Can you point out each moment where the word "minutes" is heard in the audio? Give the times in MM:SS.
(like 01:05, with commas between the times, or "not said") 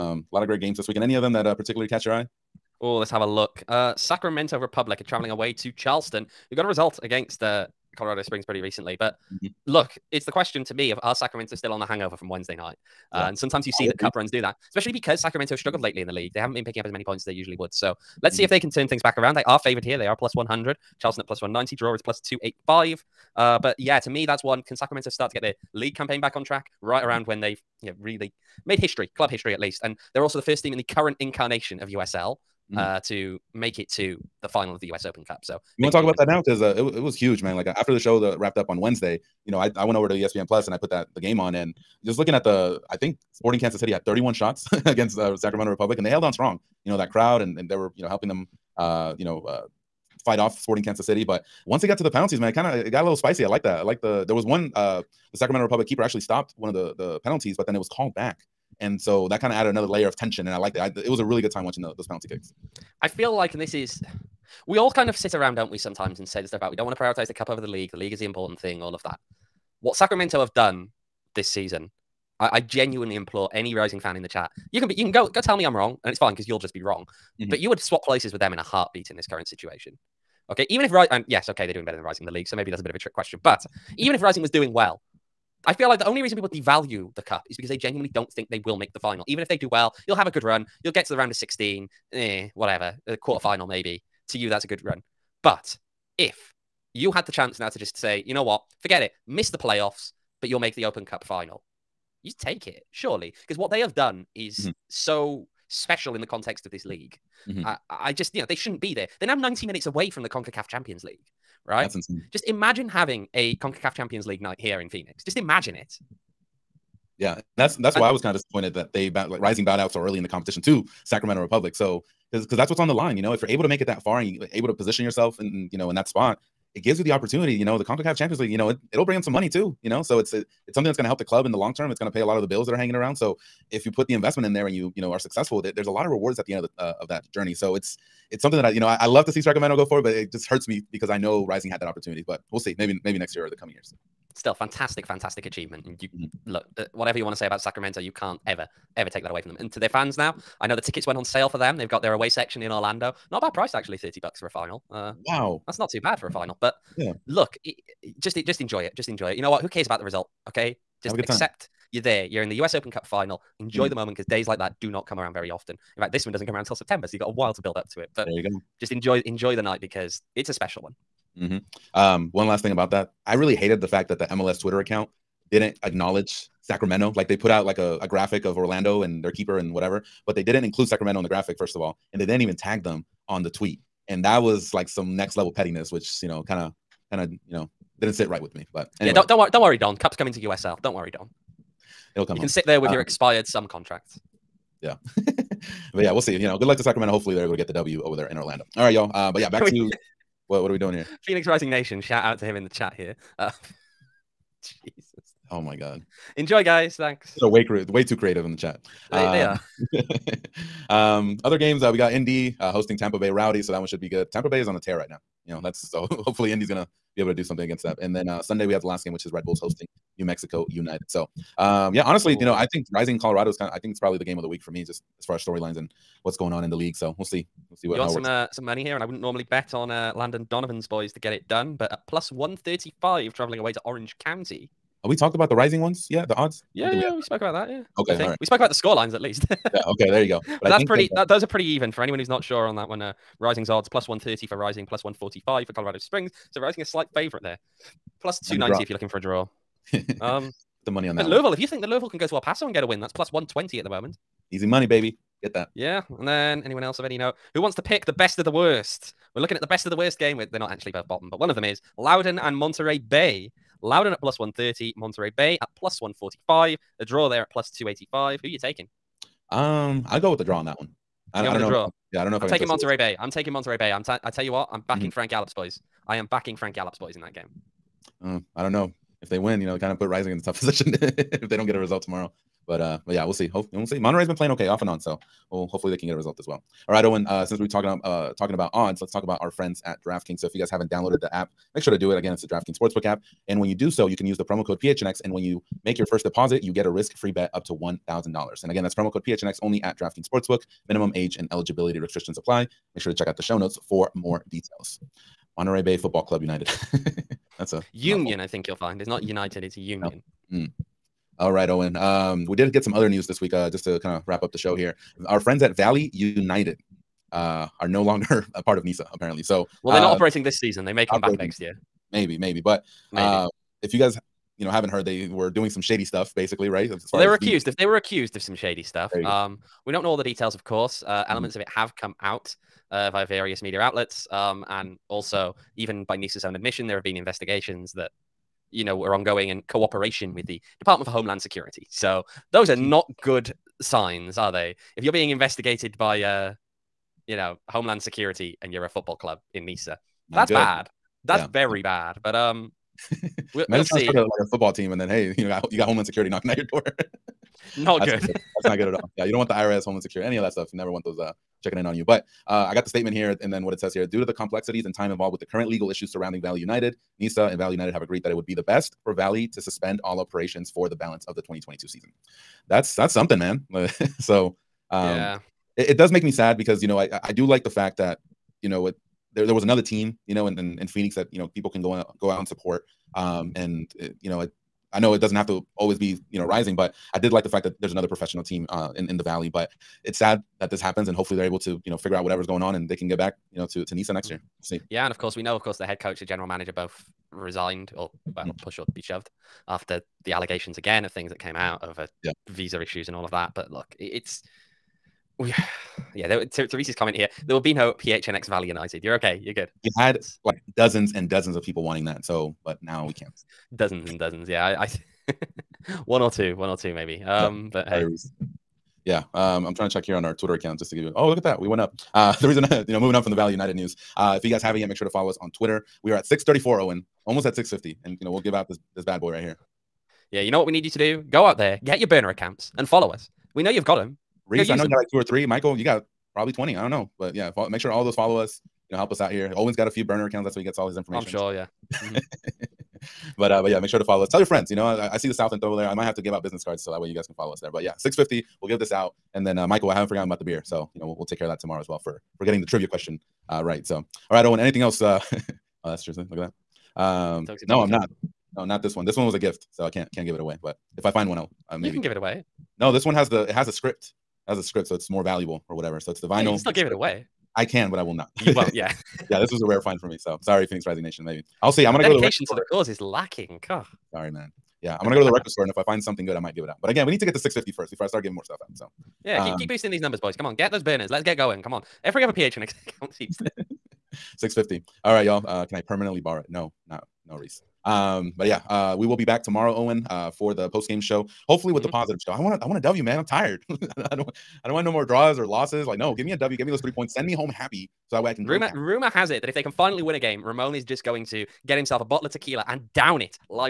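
01:49.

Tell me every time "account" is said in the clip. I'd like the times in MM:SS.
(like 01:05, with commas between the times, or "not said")
02:54, 07:00, 07:12, 07:20, 08:02.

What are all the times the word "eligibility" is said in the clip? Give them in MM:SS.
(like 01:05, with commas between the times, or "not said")
05:01.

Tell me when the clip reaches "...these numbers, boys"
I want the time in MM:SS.
07:59.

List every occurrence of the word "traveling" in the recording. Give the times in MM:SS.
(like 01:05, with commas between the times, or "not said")
00:05, 03:53.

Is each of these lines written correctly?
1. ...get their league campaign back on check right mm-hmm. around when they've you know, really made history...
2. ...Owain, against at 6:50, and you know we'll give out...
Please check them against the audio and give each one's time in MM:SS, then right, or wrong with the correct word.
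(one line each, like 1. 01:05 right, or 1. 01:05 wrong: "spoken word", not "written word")
1. 00:25 wrong: "track", not "check"
2. 07:06 wrong: "almost", not "against".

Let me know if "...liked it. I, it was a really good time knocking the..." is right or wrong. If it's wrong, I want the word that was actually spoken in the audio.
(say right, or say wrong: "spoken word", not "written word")
wrong: "watching", not "knocking".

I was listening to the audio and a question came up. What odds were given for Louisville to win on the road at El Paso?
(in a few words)
+120.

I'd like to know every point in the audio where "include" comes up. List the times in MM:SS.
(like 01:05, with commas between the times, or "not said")
03:00.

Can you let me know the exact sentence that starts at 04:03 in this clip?
Uh, Rising's odds plus 130 for Rising, plus 145 for Colorado Springs.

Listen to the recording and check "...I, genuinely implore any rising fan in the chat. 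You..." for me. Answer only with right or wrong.
right.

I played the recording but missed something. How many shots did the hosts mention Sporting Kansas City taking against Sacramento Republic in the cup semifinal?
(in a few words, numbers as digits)
31.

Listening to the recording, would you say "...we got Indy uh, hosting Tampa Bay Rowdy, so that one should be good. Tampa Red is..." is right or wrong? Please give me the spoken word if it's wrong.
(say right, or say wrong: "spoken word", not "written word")
wrong: "Bay", not "Red".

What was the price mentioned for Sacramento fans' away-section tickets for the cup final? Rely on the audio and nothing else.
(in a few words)
$30.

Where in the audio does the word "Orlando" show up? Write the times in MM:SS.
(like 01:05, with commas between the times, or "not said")
02:32, 02:58, 03:18.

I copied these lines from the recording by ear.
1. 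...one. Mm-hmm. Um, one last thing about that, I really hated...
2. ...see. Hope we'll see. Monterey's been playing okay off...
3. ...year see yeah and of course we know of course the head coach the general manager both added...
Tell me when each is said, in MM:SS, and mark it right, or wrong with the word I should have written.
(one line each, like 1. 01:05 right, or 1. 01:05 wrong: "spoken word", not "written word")
1. 02:50 right
2. 04:43 right
3. 06:34 wrong: "resigned", not "added".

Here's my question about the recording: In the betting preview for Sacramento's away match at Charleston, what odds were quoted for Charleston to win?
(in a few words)
+190.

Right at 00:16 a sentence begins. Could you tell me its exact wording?
They haven't been picking up as many points as they usually would.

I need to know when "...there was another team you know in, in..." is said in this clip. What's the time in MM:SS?
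06:19.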